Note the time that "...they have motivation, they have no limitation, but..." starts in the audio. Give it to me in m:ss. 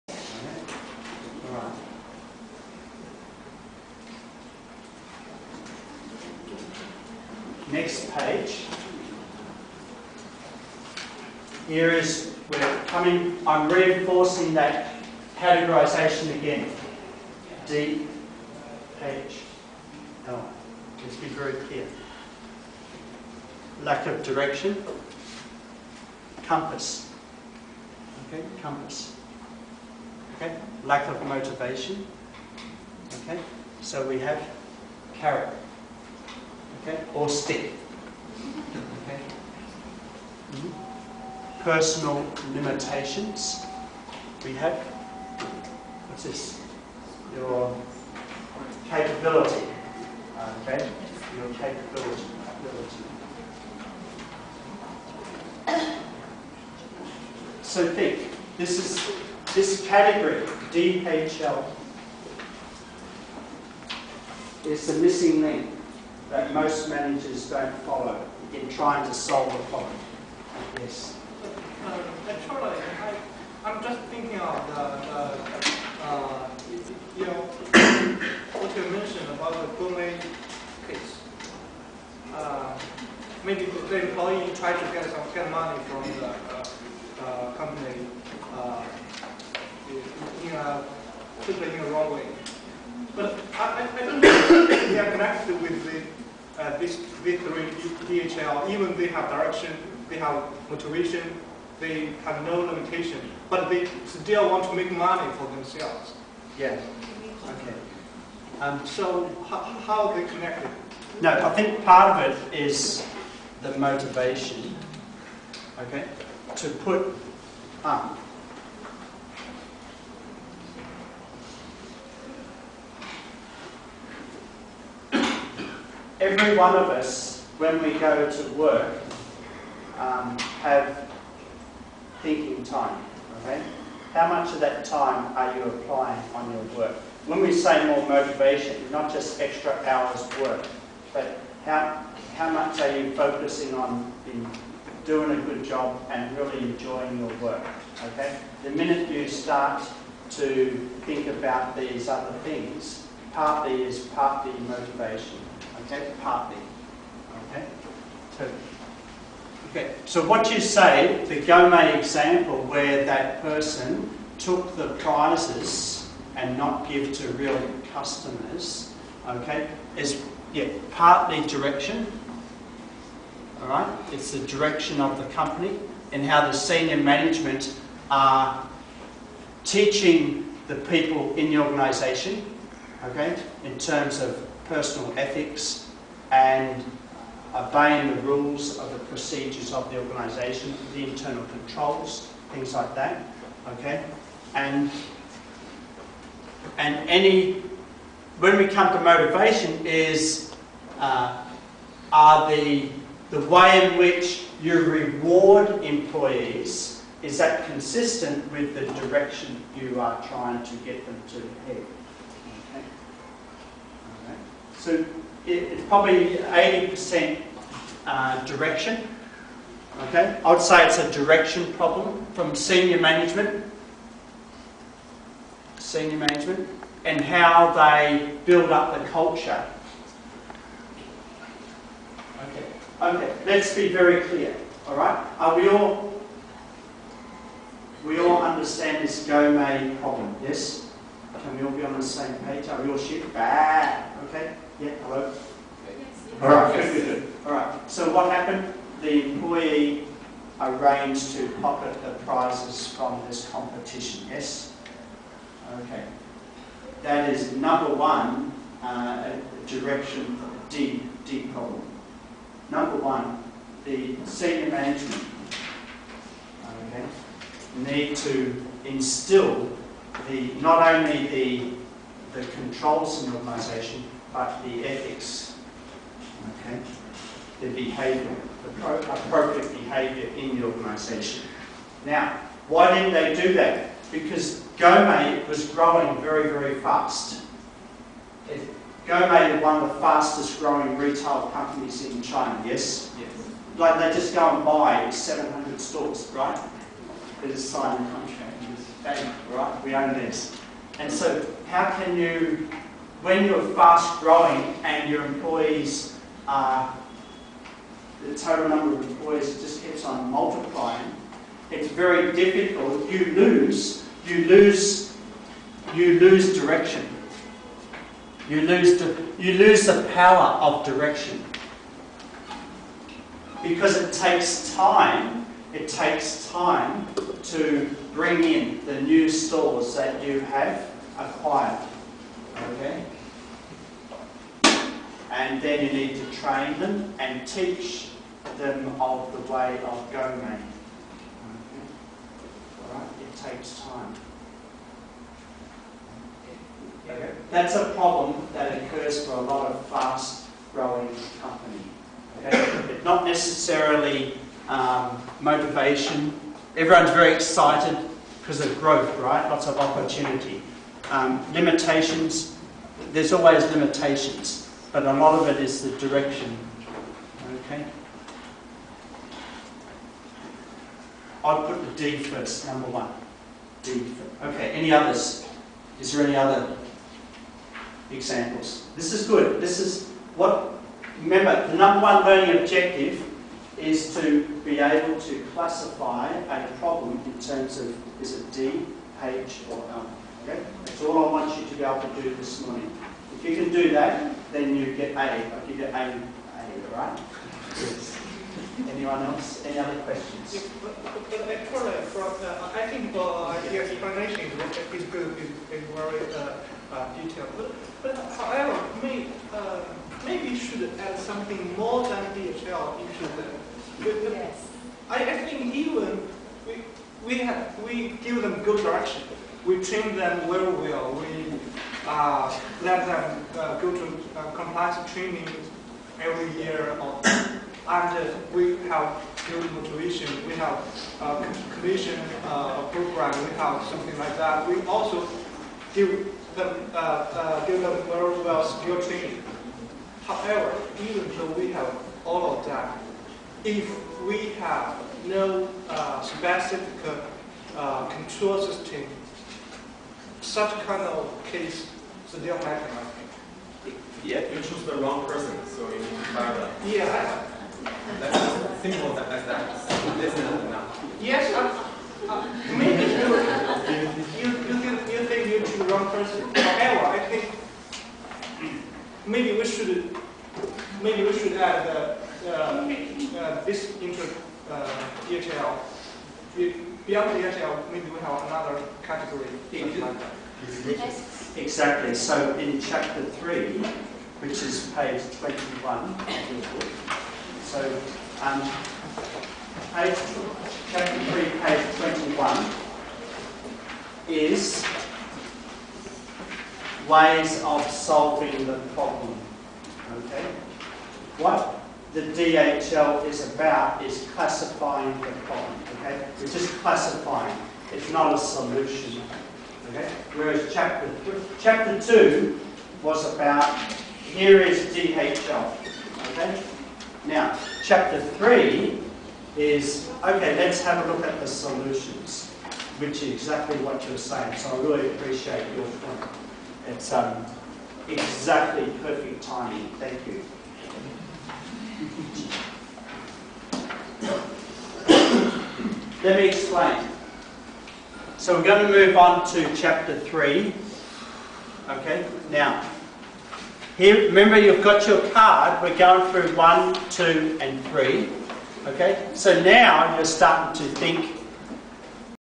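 1:40.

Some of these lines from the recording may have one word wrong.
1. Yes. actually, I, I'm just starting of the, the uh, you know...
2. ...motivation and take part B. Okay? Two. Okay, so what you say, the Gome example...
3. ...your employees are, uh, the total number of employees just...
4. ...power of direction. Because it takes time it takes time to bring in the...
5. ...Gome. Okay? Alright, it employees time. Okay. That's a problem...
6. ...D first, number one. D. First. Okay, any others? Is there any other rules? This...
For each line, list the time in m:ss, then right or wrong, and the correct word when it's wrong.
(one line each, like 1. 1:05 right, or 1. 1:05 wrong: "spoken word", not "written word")
1. 1:10 wrong: "thinking", not "starting"
2. 2:34 right
3. 5:05 right
4. 5:20 right
5. 5:40 wrong: "takes", not "employees"
6. 6:12 wrong: "examples", not "rules".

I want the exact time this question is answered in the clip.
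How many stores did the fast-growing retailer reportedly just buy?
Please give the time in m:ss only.
4:55.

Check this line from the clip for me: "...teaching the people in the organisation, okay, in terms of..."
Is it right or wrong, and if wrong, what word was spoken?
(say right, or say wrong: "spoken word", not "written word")
right.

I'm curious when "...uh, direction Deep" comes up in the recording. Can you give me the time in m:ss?
4:18.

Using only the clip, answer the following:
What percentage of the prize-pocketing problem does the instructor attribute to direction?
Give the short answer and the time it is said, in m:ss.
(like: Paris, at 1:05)
80%, at 3:36.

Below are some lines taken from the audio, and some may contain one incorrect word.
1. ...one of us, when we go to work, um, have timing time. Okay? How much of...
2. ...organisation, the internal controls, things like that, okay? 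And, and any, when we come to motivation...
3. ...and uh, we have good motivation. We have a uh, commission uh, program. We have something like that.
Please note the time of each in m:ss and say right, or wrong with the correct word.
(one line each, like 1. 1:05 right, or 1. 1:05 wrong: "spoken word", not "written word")
1. 2:06 wrong: "thinking", not "timing"
2. 3:09 right
3. 7:07 right.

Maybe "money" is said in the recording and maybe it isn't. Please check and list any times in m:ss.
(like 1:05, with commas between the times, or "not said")
1:25, 1:44.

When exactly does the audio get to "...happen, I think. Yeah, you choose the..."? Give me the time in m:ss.
7:32.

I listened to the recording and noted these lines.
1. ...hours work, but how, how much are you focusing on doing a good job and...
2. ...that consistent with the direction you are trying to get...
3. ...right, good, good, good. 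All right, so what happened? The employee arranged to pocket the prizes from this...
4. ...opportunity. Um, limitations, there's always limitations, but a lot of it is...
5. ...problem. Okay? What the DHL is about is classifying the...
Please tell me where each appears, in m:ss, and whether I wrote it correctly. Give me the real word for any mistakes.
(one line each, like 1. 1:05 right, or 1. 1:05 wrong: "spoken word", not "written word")
1. 2:19 right
2. 3:27 right
3. 4:06 right
4. 5:59 right
5. 8:18 right.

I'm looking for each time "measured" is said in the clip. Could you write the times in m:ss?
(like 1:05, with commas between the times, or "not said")
not said.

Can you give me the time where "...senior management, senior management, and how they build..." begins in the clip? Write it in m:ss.
3:42.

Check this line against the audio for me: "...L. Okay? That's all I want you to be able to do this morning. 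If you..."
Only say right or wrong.
right.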